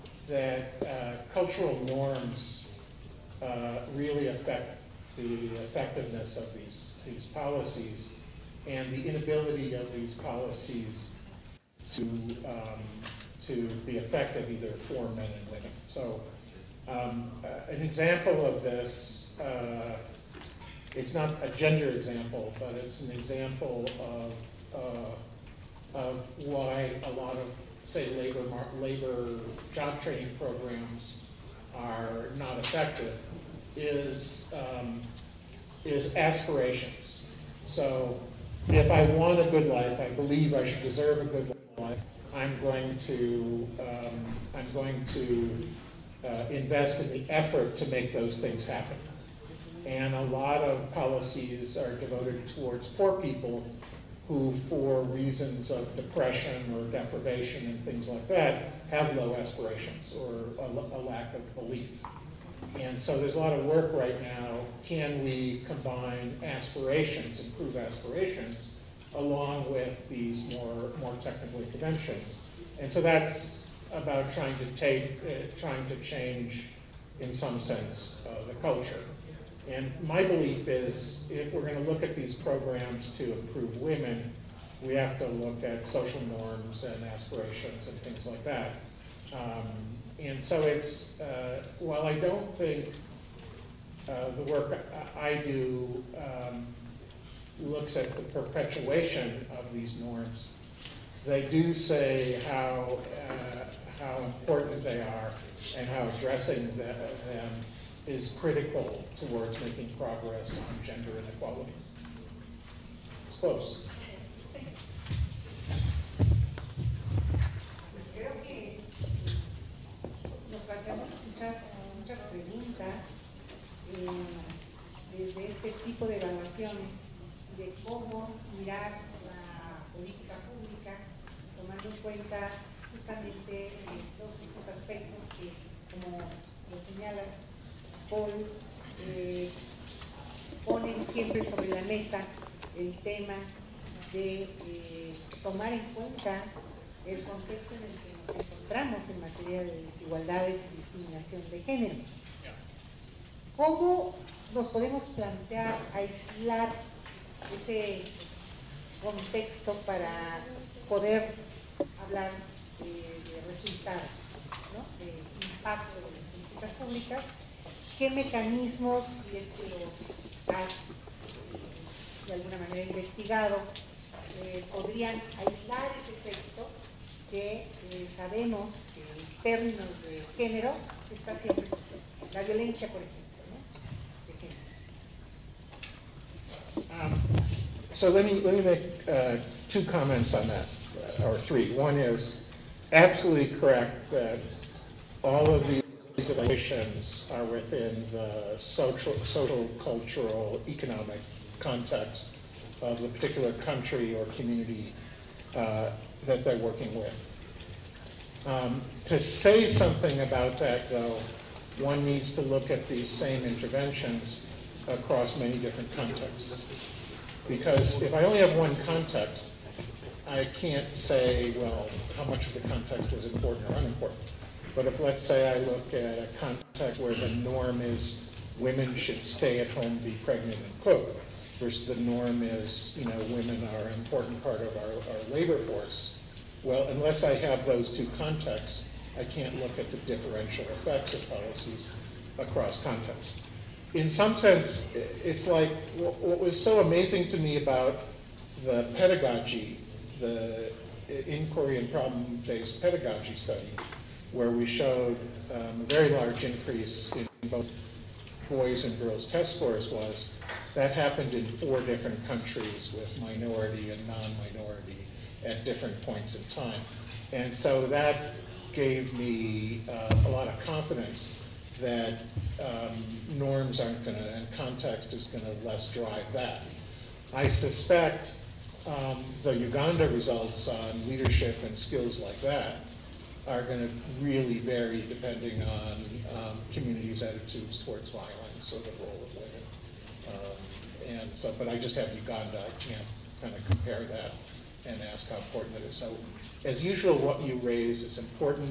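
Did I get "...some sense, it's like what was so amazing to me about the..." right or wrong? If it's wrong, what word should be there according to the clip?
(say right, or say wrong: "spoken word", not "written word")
right.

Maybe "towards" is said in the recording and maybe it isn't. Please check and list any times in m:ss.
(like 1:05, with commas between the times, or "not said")
0:52, 1:49, 4:47.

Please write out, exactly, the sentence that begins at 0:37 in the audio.
So if I want a good life, I believe I should deserve a good life.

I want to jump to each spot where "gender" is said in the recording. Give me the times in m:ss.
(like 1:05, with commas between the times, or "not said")
0:21, 1:50.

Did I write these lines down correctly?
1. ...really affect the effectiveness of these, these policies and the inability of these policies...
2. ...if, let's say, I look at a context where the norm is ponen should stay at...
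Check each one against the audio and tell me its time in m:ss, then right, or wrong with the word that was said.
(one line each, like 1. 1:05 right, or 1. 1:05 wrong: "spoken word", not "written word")
1. 0:03 right
2. 3:44 wrong: "women", not "ponen".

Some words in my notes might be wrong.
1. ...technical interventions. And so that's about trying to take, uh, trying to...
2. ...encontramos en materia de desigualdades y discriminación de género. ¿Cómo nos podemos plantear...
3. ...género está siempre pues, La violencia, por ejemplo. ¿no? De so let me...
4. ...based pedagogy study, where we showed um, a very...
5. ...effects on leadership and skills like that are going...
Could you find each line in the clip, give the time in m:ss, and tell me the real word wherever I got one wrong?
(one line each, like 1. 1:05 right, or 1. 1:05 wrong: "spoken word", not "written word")
1. 1:11 right
2. 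2:28 right
3. 3:00 right
4. 4:12 right
5. 4:40 wrong: "results", not "effects".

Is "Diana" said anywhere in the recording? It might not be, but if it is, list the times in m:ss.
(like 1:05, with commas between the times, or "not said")
not said.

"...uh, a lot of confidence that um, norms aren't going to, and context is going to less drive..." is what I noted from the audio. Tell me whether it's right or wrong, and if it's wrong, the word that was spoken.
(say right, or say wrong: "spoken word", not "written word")
right.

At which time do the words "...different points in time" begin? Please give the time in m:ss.
4:25.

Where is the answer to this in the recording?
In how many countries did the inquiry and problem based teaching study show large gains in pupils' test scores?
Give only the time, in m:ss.
4:21.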